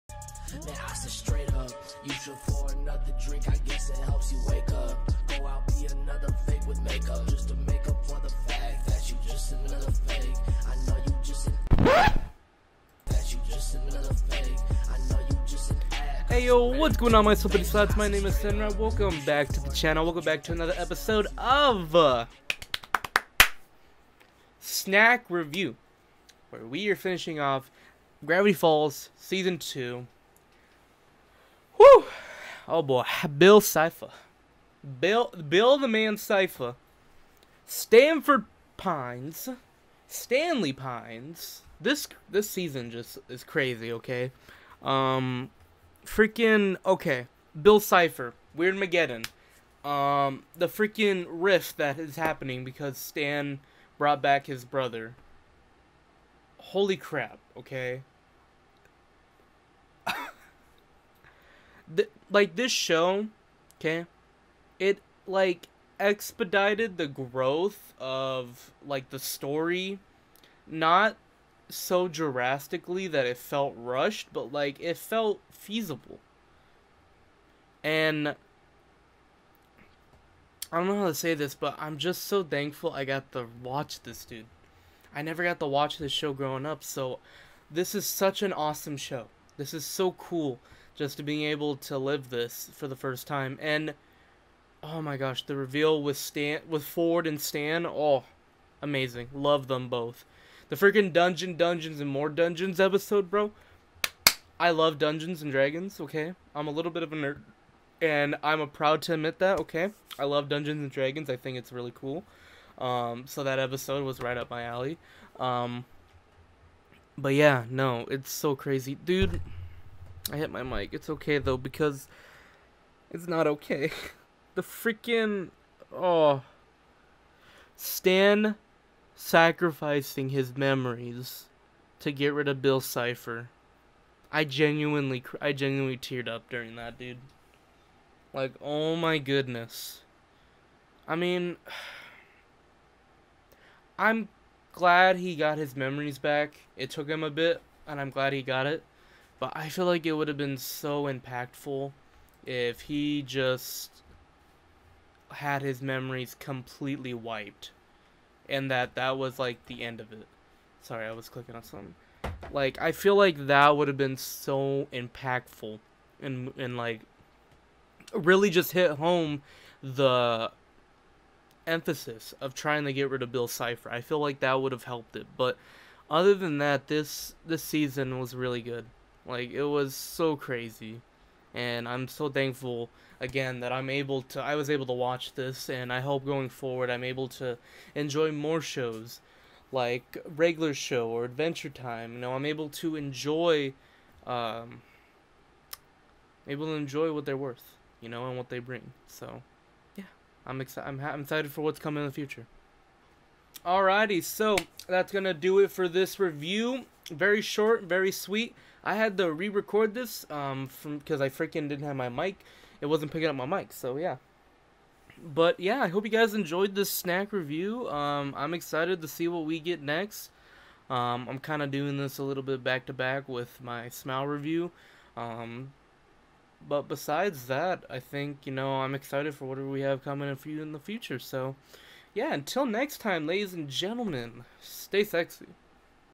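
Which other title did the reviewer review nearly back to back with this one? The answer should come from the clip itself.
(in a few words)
Smile.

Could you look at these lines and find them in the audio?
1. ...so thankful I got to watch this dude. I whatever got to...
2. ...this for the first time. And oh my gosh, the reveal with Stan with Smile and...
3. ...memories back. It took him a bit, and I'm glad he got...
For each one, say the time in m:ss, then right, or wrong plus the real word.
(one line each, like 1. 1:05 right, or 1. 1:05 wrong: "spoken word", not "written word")
1. 1:22 wrong: "never", not "whatever"
2. 1:32 wrong: "Ford", not "Smile"
3. 2:25 right.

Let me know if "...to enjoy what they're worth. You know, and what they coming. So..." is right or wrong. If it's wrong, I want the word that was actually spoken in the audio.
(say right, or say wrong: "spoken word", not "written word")
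wrong: "bring", not "coming".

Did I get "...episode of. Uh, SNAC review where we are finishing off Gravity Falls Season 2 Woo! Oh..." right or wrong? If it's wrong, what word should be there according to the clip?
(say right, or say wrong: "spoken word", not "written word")
right.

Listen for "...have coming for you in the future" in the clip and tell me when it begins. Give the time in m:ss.
3:49.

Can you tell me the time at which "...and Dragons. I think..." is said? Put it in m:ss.
1:50.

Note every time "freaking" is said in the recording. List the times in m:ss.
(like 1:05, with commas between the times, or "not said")
0:46, 0:50, 1:40, 2:04, 3:31.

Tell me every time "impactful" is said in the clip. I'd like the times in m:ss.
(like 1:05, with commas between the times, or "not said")
2:31, 2:44.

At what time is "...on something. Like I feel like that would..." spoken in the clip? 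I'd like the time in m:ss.
2:41.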